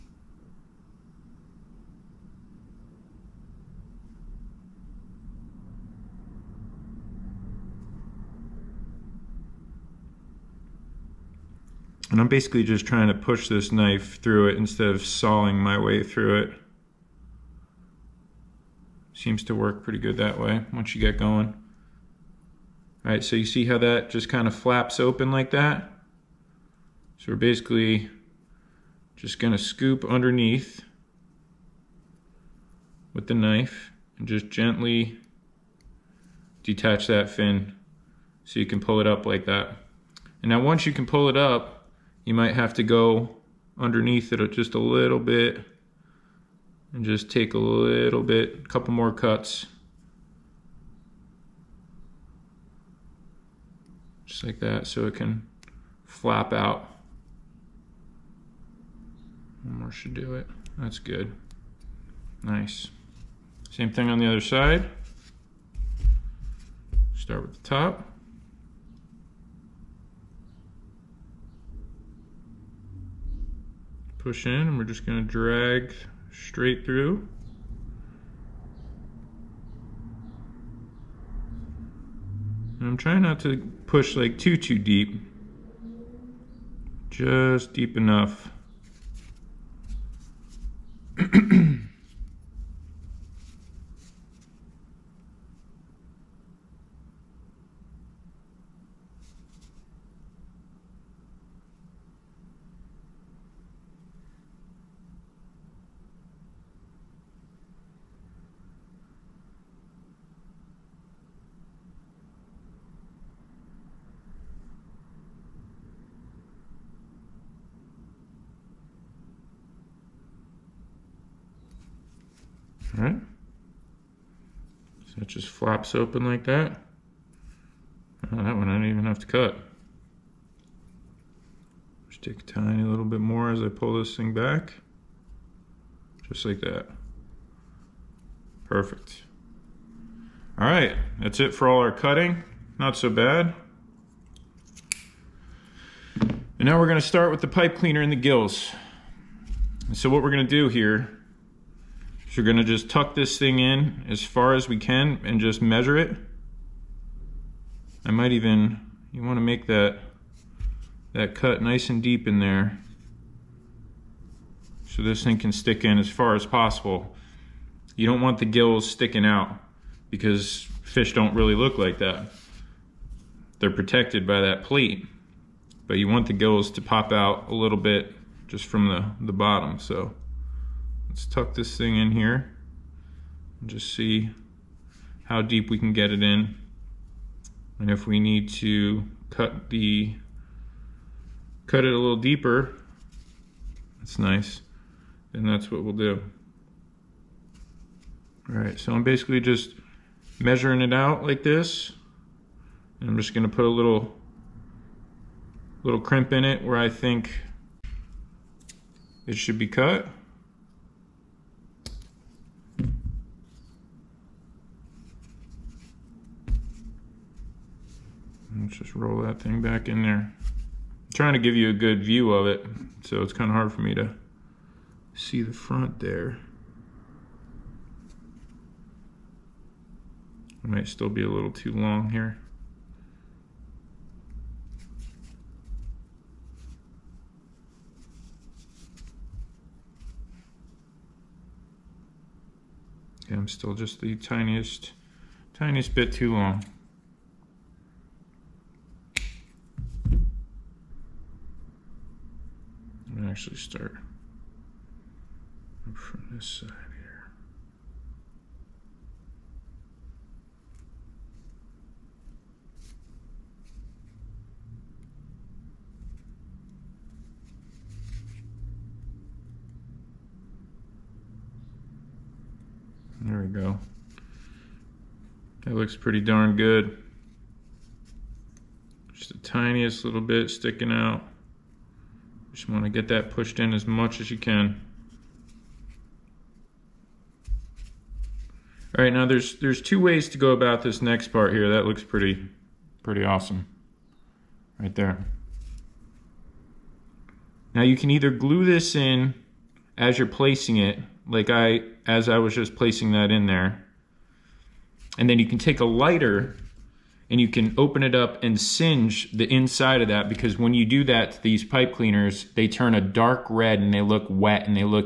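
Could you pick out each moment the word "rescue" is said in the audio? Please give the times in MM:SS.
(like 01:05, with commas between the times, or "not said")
not said.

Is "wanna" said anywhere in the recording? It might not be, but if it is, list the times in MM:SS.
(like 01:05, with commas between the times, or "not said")
02:39.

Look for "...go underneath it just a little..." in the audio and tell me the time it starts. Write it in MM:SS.
00:42.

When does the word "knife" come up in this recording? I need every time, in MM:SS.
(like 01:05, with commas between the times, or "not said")
00:13, 00:33.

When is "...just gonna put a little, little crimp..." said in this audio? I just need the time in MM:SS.
03:23.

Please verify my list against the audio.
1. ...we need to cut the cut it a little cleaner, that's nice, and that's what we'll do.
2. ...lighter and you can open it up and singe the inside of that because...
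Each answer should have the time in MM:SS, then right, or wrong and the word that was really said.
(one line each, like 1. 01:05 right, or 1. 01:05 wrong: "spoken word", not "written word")
1. 03:08 wrong: "deeper", not "cleaner"
2. 05:05 right.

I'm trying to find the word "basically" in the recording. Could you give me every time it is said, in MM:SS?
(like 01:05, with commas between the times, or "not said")
00:12, 00:27, 03:19.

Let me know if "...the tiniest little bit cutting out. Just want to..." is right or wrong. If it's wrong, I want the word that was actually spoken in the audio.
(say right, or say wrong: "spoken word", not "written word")
wrong: "sticking", not "cutting".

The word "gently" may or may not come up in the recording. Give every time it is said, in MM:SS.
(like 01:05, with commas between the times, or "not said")
00:34.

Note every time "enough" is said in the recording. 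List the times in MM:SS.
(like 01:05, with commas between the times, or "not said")
01:27.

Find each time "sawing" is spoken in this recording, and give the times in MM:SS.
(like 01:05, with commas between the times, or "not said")
00:15.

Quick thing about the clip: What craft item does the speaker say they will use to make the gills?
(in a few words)
pipe cleaner.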